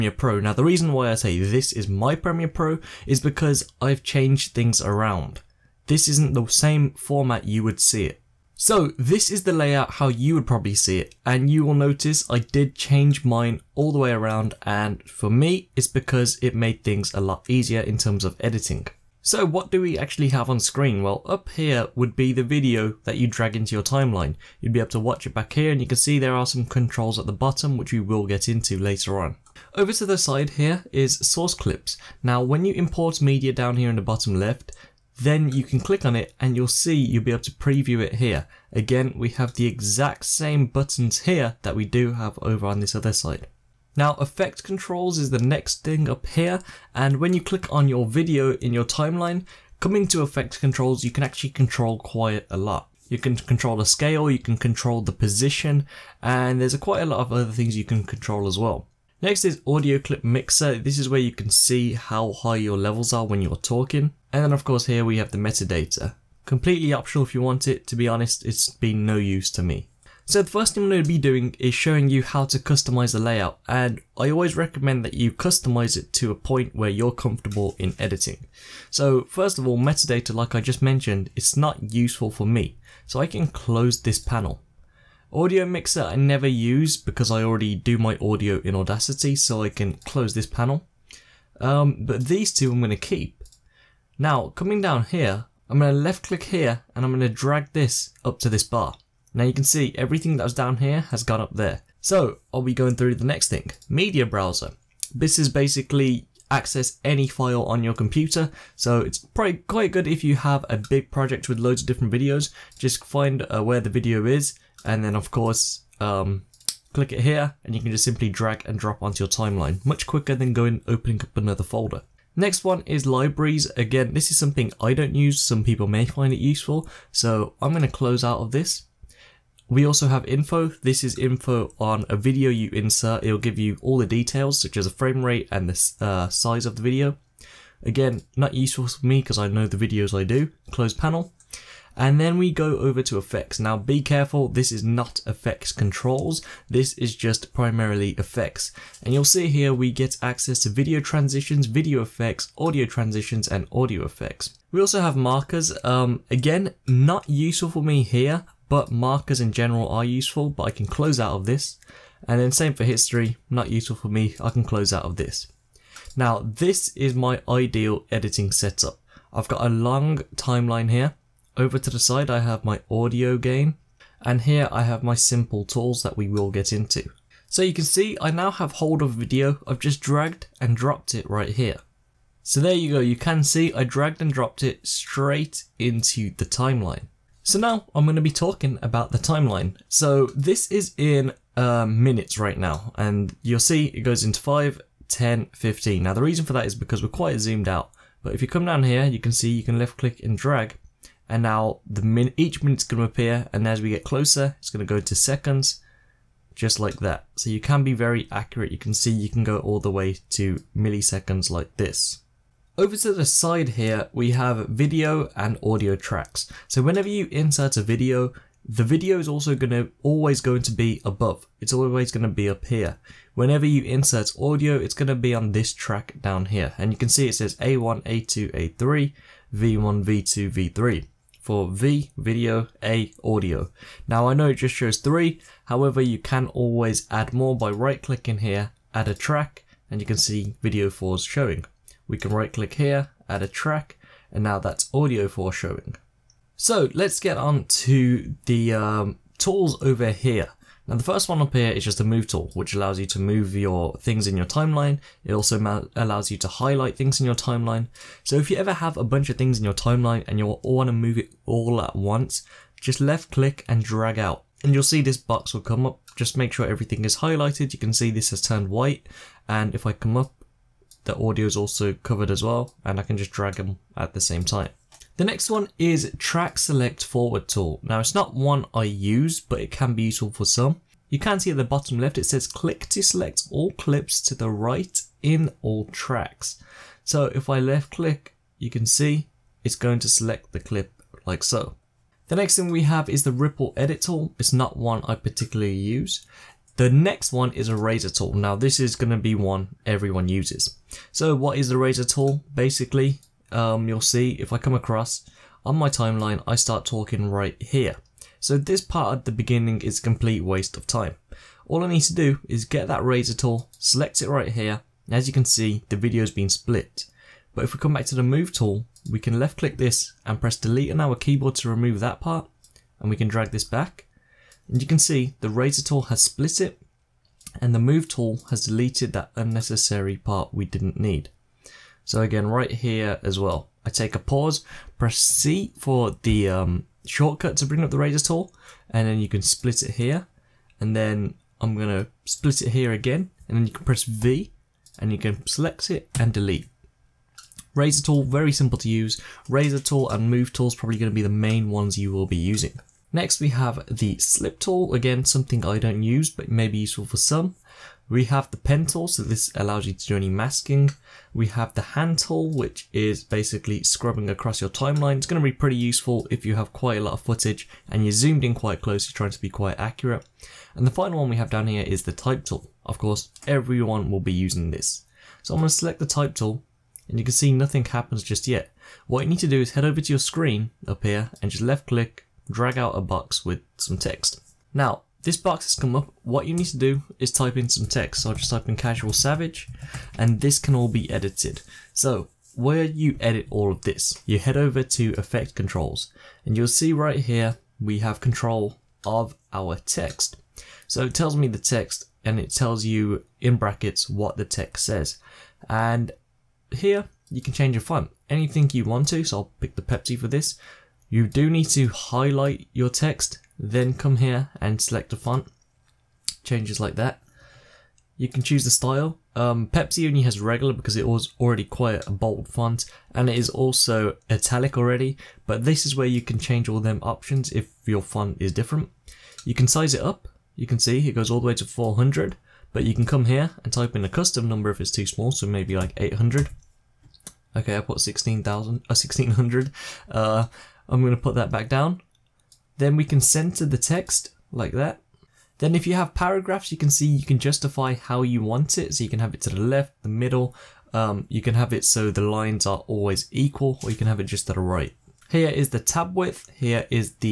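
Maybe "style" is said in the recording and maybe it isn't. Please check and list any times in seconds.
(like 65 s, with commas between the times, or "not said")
418 s.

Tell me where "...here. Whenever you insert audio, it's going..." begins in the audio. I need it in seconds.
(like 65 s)
222 s.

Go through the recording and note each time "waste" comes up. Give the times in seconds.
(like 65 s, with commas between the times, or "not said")
310 s.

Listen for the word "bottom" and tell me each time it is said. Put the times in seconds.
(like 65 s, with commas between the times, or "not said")
27 s, 34 s, 281 s.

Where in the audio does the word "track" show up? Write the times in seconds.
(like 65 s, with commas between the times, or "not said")
215 s, 225 s, 239 s, 243 s, 276 s, 285 s.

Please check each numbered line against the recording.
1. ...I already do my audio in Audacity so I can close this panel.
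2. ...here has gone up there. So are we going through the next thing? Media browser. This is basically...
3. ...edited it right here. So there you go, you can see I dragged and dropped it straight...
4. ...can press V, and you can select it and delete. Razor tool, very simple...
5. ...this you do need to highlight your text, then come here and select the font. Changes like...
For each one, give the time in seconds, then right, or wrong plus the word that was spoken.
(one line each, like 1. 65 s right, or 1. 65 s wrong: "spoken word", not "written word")
1. 87 s right
2. 100 s right
3. 180 s wrong: "dropped", not "edited"
4. 343 s right
5. 410 s right.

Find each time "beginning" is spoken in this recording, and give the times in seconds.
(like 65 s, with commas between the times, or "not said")
309 s.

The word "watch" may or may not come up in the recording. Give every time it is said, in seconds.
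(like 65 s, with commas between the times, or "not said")
24 s.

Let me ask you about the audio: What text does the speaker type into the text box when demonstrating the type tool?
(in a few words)
casual savage.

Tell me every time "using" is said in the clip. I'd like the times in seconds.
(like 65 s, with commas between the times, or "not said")
352 s, 374 s.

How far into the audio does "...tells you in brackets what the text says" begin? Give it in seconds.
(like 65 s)
402 s.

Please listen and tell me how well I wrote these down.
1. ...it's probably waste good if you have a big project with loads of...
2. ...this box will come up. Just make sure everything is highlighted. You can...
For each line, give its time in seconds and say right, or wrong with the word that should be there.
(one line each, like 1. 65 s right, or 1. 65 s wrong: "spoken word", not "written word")
1. 109 s wrong: "quite", not "waste"
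2. 265 s right.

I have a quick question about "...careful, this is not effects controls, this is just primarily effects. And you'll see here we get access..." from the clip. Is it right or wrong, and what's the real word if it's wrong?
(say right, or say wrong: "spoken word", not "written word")
right.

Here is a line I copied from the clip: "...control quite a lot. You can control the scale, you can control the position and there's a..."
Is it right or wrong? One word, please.
right.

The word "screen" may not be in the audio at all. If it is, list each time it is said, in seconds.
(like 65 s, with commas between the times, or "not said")
20 s, 380 s.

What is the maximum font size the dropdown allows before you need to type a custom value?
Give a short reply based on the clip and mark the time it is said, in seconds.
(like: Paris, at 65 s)
400, at 431 s.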